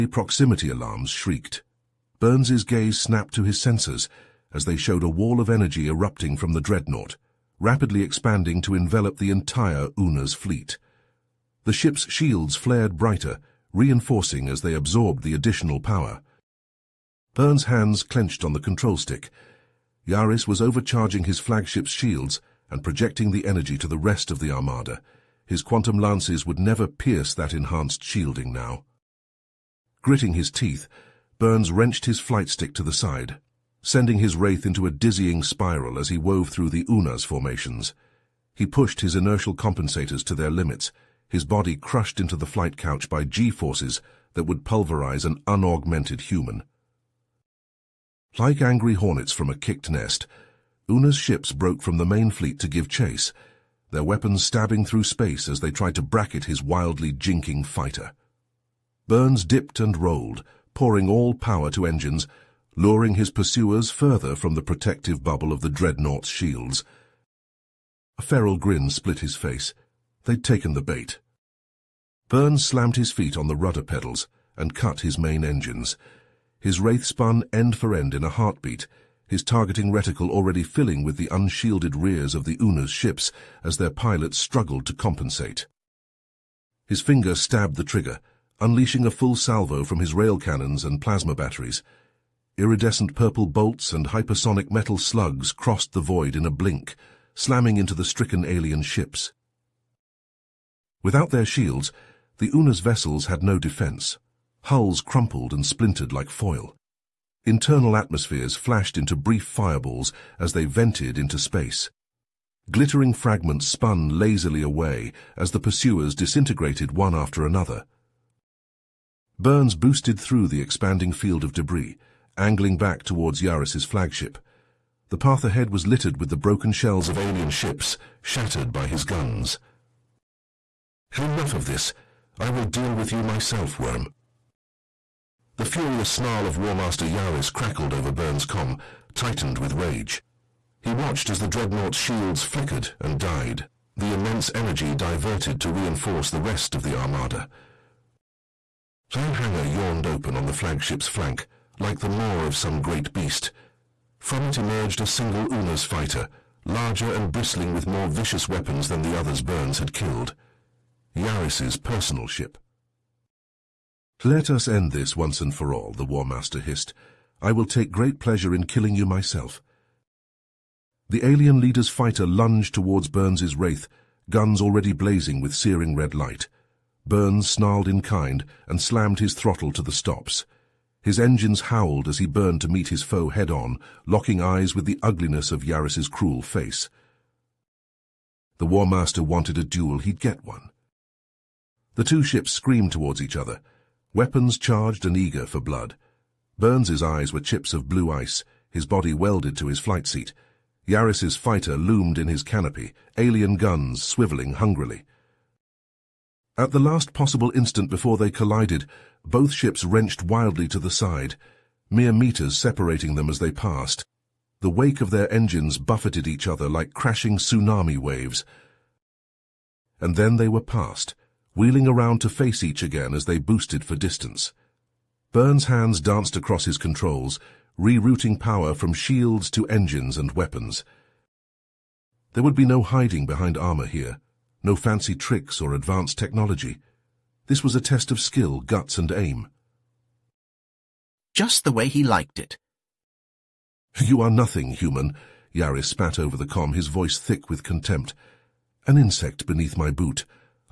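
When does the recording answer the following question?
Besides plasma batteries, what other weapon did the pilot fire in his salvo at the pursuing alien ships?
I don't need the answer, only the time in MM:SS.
01:30.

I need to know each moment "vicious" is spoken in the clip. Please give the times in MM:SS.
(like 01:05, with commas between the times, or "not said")
02:38.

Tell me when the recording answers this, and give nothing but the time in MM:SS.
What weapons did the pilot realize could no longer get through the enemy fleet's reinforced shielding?
00:25.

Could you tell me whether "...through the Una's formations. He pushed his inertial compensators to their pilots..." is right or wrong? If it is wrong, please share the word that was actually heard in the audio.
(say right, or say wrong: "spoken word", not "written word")
wrong: "limits", not "pilots".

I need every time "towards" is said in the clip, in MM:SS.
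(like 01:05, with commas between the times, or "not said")
02:03, 02:52, 03:12.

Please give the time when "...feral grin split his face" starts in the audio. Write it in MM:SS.
01:08.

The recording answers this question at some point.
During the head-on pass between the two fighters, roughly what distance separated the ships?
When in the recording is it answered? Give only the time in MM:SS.
03:31.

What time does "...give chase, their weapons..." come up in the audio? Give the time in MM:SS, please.
00:52.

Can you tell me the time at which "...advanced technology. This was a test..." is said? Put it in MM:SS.
03:55.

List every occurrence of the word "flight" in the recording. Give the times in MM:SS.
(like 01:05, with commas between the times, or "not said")
00:32, 00:42, 03:19.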